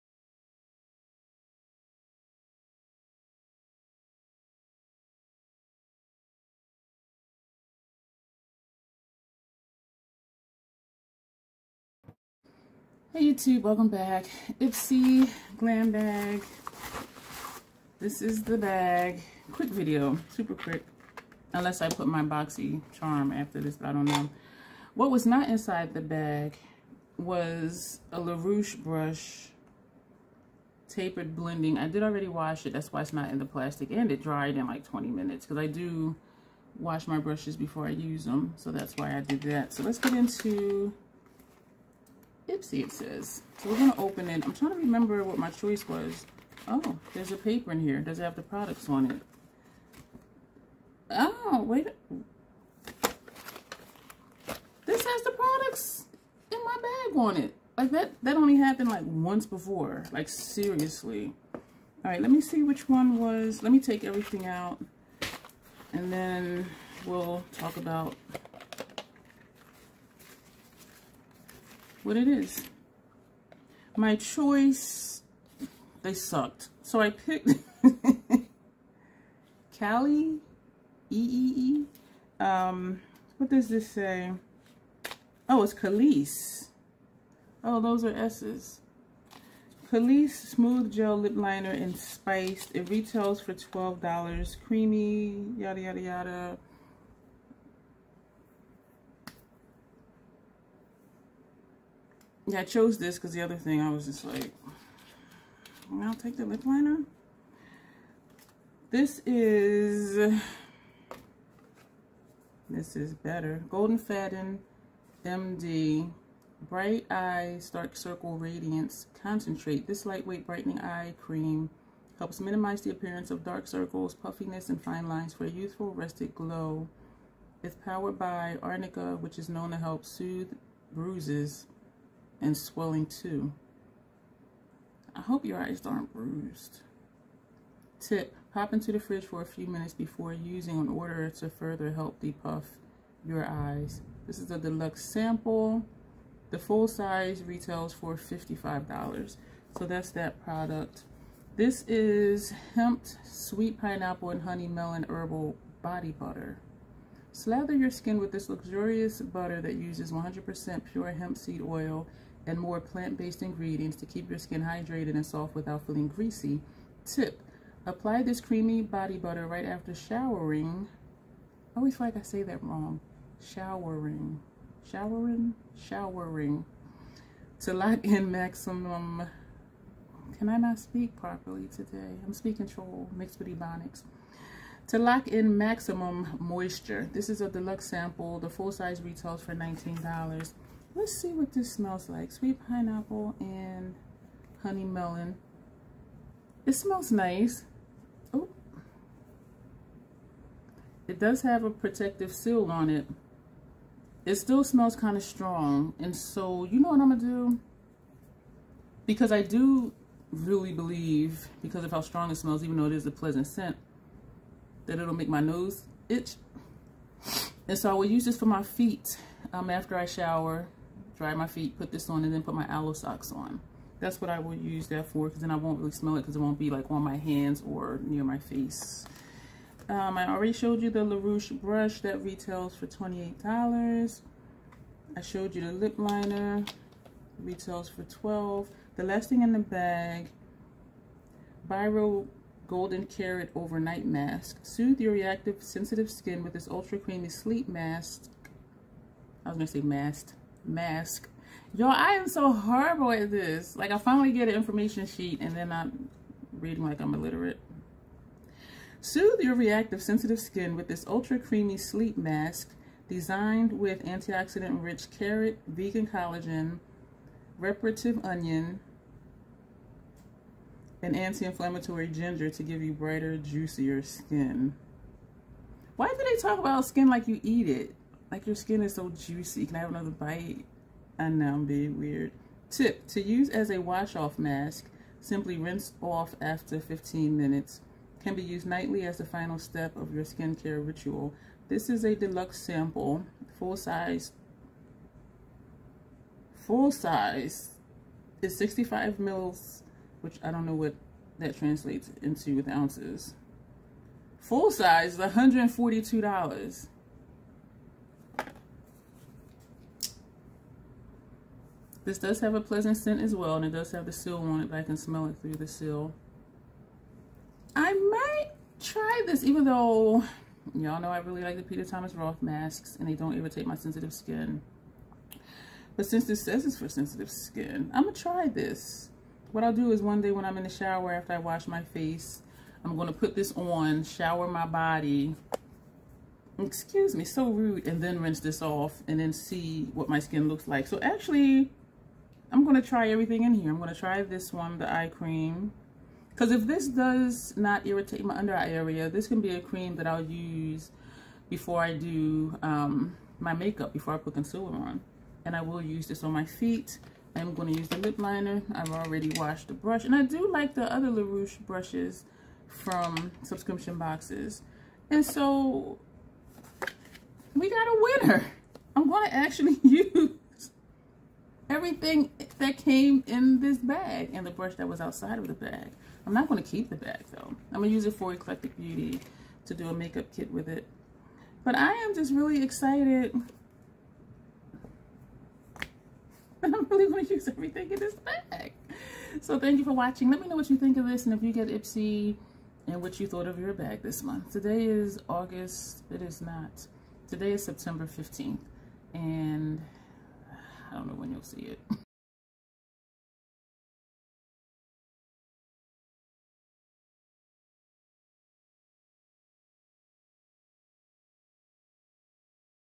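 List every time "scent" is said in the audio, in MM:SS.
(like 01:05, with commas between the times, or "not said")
03:33, 05:12.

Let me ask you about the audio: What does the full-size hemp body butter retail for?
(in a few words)
$19.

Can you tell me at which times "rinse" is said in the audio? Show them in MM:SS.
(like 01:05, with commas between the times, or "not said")
04:45, 05:38.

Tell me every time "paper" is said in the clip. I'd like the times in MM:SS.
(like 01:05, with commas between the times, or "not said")
00:47.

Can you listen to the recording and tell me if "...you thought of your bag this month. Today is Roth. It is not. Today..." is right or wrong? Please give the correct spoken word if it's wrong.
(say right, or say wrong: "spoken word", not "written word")
wrong: "August", not "Roth".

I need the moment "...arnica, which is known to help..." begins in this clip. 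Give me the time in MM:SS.
02:08.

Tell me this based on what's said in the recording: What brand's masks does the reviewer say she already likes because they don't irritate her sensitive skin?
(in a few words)
Peter Thomas Roth.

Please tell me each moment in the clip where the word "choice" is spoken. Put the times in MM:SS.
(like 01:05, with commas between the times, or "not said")
00:45, 01:14.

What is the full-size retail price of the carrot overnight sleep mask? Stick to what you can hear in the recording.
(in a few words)
$142.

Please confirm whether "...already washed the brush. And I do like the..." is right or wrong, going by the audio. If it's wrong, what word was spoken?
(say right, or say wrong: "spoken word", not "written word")
right.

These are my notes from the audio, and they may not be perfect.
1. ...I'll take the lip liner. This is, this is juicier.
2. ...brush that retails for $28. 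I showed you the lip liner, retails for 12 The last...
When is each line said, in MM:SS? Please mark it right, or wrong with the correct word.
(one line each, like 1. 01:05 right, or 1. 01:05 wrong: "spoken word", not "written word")
1. 01:46 wrong: "better", not "juicier"
2. 03:51 right.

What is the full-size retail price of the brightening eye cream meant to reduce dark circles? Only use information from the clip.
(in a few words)
$55.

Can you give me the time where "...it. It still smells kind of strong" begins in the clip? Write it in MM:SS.
03:22.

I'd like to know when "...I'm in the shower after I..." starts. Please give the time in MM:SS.
05:30.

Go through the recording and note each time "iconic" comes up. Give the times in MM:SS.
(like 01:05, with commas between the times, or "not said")
not said.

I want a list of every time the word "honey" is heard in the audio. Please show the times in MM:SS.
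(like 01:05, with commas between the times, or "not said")
02:34, 03:14.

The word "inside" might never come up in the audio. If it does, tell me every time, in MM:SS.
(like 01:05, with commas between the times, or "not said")
00:25.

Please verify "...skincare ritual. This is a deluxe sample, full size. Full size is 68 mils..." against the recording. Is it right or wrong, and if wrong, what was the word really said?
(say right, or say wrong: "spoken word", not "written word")
wrong: "65", not "68".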